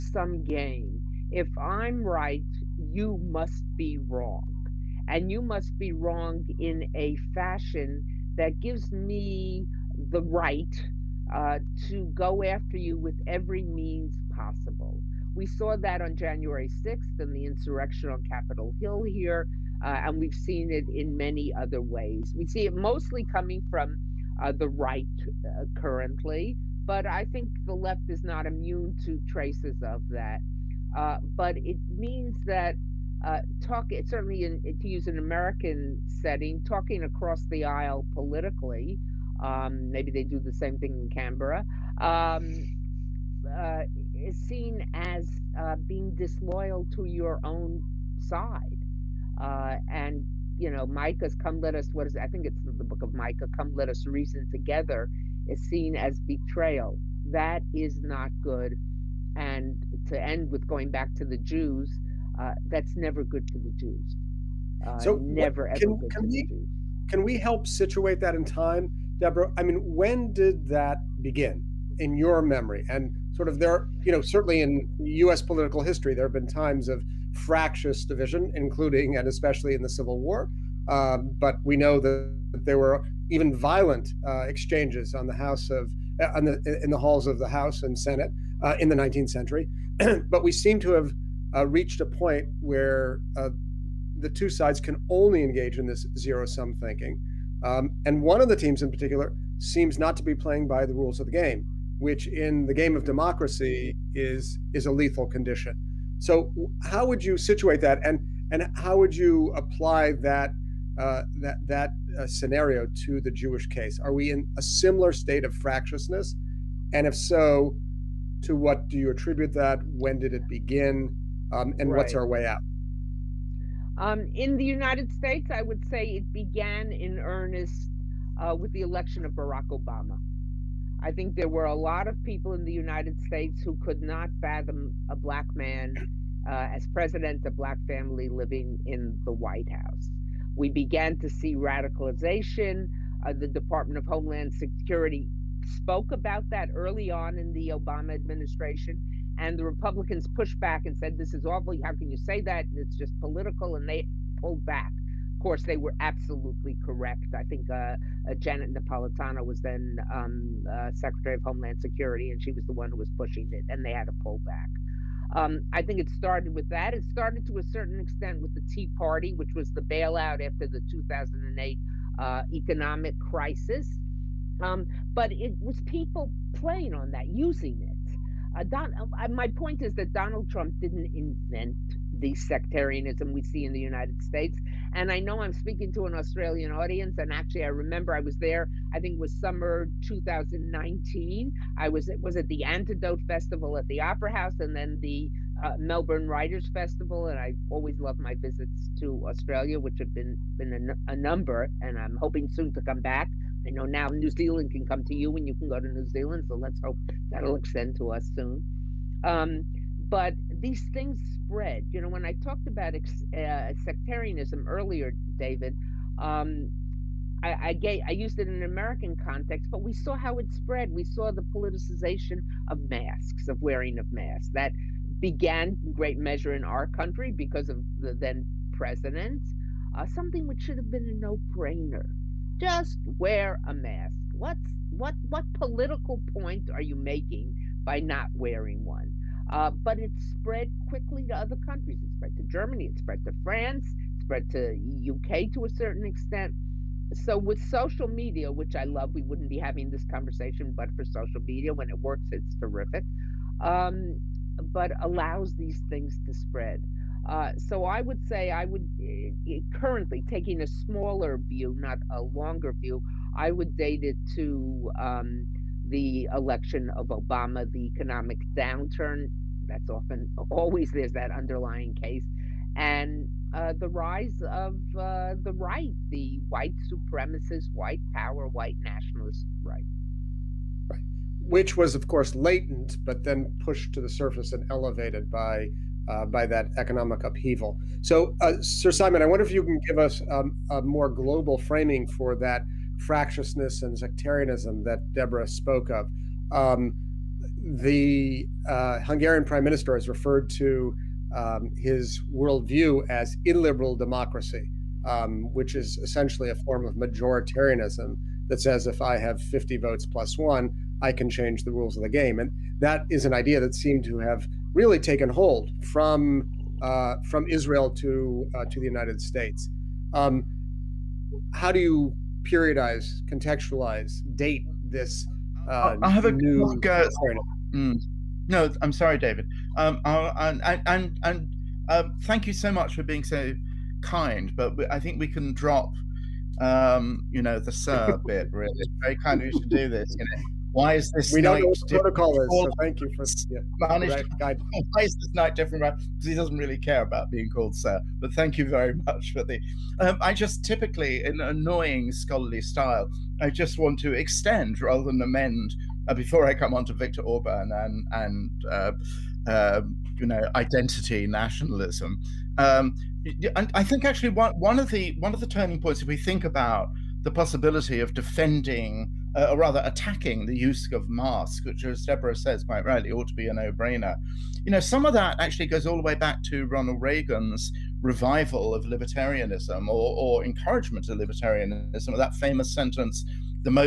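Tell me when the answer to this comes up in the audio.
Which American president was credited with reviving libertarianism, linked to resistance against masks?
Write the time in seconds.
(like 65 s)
376 s.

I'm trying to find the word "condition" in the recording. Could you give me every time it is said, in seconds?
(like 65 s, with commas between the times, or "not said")
105 s.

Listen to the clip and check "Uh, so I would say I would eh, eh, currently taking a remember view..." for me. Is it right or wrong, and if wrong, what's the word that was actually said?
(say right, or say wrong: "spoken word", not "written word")
wrong: "smaller", not "remember".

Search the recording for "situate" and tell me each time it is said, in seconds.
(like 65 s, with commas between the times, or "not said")
67 s, 107 s.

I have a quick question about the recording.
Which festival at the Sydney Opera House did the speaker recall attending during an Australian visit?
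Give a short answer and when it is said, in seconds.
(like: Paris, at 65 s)
Antidote Festival, at 192 s.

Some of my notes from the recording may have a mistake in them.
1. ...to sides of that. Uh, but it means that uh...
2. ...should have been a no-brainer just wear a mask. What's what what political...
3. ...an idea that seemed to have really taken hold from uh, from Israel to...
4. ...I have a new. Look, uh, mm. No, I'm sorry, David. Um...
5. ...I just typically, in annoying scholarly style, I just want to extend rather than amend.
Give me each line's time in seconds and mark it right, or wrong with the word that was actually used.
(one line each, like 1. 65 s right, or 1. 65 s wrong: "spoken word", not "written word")
1. 29 s wrong: "traces", not "sides"
2. 230 s right
3. 313 s right
4. 326 s right
5. 350 s right.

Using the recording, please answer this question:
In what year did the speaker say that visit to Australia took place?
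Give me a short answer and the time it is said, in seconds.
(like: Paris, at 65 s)
2019, at 190 s.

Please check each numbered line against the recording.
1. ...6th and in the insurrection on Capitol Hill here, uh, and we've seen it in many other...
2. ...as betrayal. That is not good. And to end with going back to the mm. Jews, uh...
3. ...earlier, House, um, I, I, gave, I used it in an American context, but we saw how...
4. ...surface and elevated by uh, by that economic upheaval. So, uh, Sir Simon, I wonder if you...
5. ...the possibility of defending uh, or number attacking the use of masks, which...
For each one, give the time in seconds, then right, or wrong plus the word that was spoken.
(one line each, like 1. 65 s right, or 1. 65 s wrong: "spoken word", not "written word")
1. 16 s right
2. 55 s right
3. 214 s wrong: "David", not "House"
4. 284 s right
5. 367 s wrong: "rather", not "number".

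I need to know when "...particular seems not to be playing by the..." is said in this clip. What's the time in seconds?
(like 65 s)
98 s.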